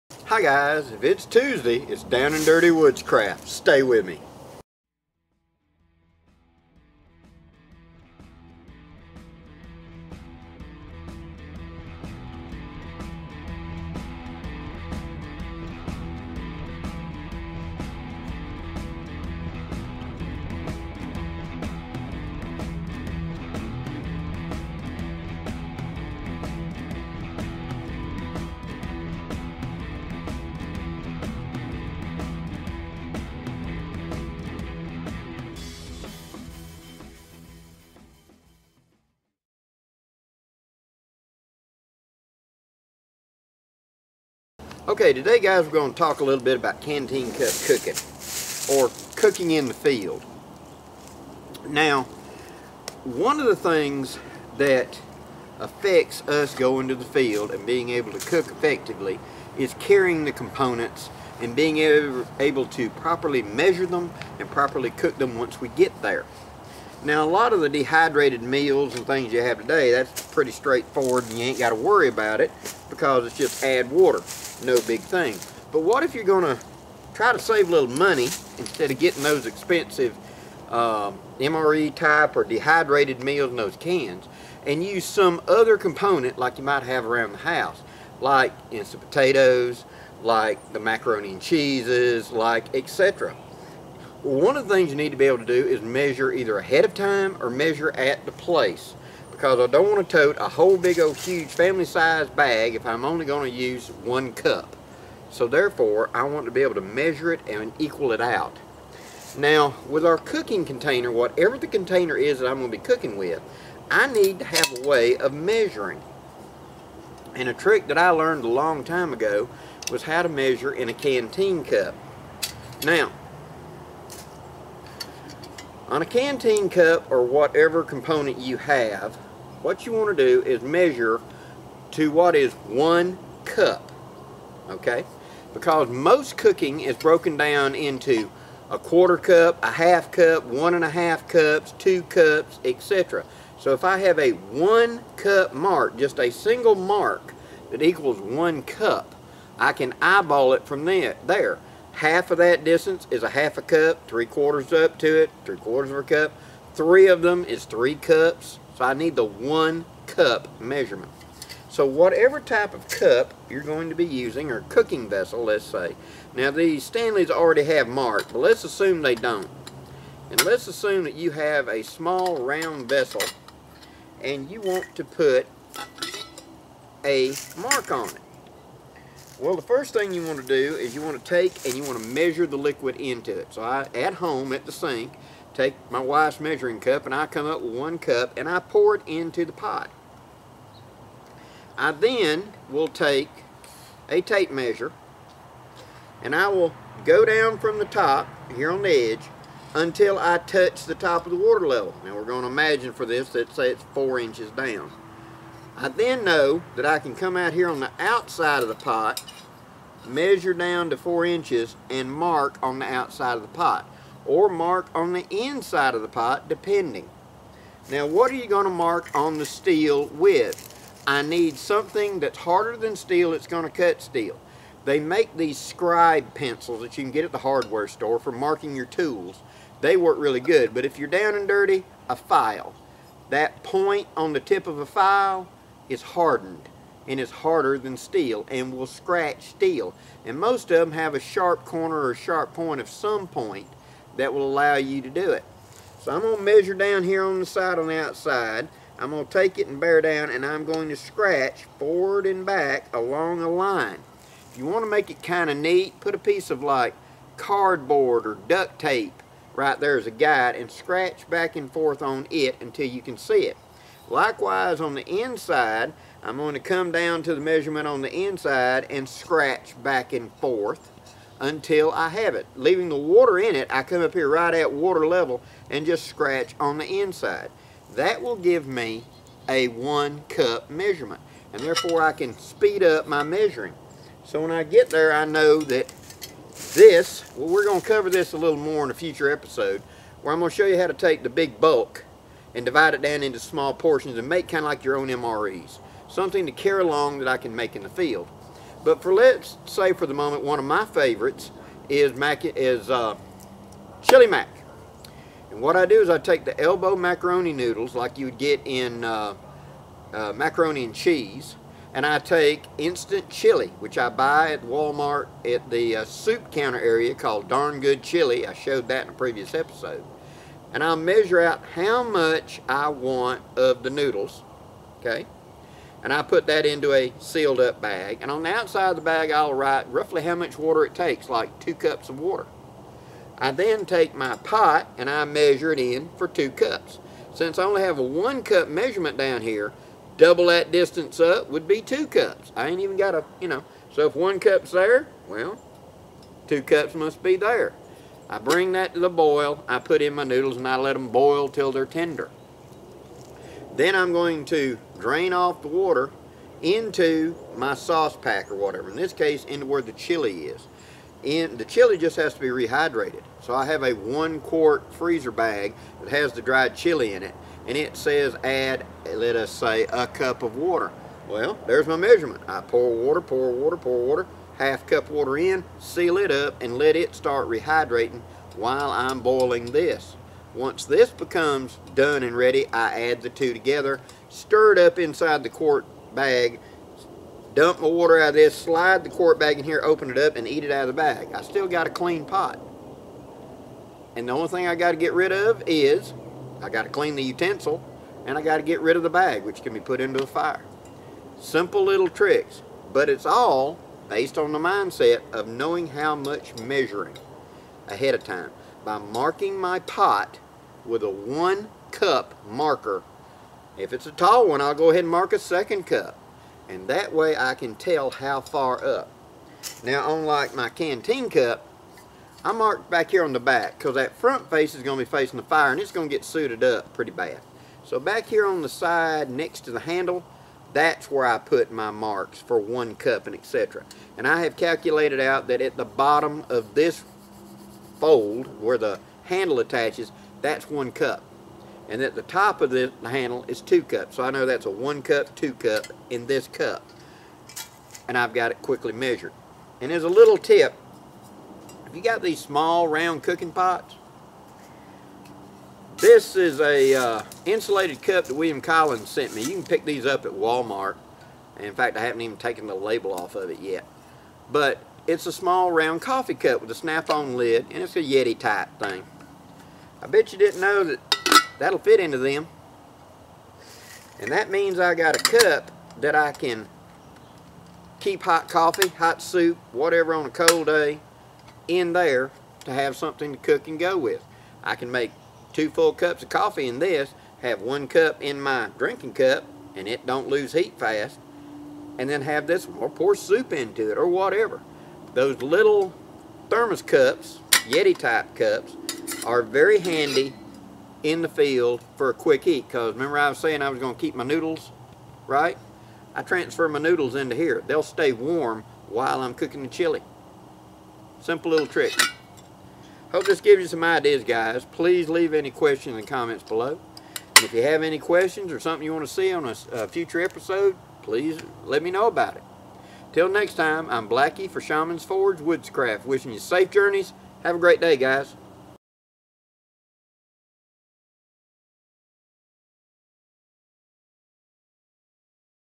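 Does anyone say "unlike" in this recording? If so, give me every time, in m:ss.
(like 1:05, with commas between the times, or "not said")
7:00.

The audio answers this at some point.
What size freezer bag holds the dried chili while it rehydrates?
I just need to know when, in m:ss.
6:03.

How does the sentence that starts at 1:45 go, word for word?
So therefore, I want to be able to measure it and equal it out.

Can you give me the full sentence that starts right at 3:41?
I need something that's harder than steel It's going to cut steel.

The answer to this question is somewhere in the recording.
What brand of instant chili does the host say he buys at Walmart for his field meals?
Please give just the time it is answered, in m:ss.
5:17.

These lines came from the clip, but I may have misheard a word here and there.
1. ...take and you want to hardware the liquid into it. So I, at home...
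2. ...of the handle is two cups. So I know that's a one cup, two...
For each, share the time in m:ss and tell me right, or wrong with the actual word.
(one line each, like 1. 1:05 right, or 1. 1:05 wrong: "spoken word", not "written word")
1. 3:01 wrong: "measure", not "hardware"
2. 7:22 right.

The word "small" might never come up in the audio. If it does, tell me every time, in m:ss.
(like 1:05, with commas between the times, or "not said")
2:51, 4:53, 7:32, 7:45.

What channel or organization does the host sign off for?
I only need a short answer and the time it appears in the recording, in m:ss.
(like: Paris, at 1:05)
Shaman's Forge Woodscraft, at 8:44.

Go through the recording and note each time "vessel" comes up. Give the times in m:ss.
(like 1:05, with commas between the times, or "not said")
2:45, 2:52.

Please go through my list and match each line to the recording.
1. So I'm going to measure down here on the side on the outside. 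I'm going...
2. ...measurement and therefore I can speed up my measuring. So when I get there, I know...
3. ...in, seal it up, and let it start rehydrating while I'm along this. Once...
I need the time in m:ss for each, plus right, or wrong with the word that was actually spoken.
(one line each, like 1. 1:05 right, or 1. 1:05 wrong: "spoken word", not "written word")
1. 4:06 right
2. 4:40 right
3. 6:15 wrong: "boiling", not "along".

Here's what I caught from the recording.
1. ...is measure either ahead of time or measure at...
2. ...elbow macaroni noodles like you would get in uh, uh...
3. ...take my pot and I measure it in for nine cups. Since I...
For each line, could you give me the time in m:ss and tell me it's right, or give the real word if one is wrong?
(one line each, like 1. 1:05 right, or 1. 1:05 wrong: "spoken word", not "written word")
1. 1:35 right
2. 5:06 right
3. 5:33 wrong: "two", not "nine".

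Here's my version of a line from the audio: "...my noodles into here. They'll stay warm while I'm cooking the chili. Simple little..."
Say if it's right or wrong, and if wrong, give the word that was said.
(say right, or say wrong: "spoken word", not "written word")
right.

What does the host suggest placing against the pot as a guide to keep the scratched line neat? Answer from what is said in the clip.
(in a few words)
Cardboard or duct tape.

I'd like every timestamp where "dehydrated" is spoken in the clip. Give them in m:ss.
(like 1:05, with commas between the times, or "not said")
1:07, 1:22.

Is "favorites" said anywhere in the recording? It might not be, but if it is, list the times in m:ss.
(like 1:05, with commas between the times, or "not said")
5:00.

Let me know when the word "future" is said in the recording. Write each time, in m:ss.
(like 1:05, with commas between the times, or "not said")
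4:48, 8:39.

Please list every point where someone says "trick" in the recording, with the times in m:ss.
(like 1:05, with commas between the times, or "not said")
1:57, 6:42, 8:31.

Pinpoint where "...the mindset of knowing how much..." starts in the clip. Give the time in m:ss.
6:44.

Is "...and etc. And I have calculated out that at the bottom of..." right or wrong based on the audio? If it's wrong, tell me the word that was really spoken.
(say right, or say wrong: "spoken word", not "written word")
right.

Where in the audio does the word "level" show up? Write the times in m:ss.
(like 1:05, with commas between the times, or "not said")
3:21, 4:35.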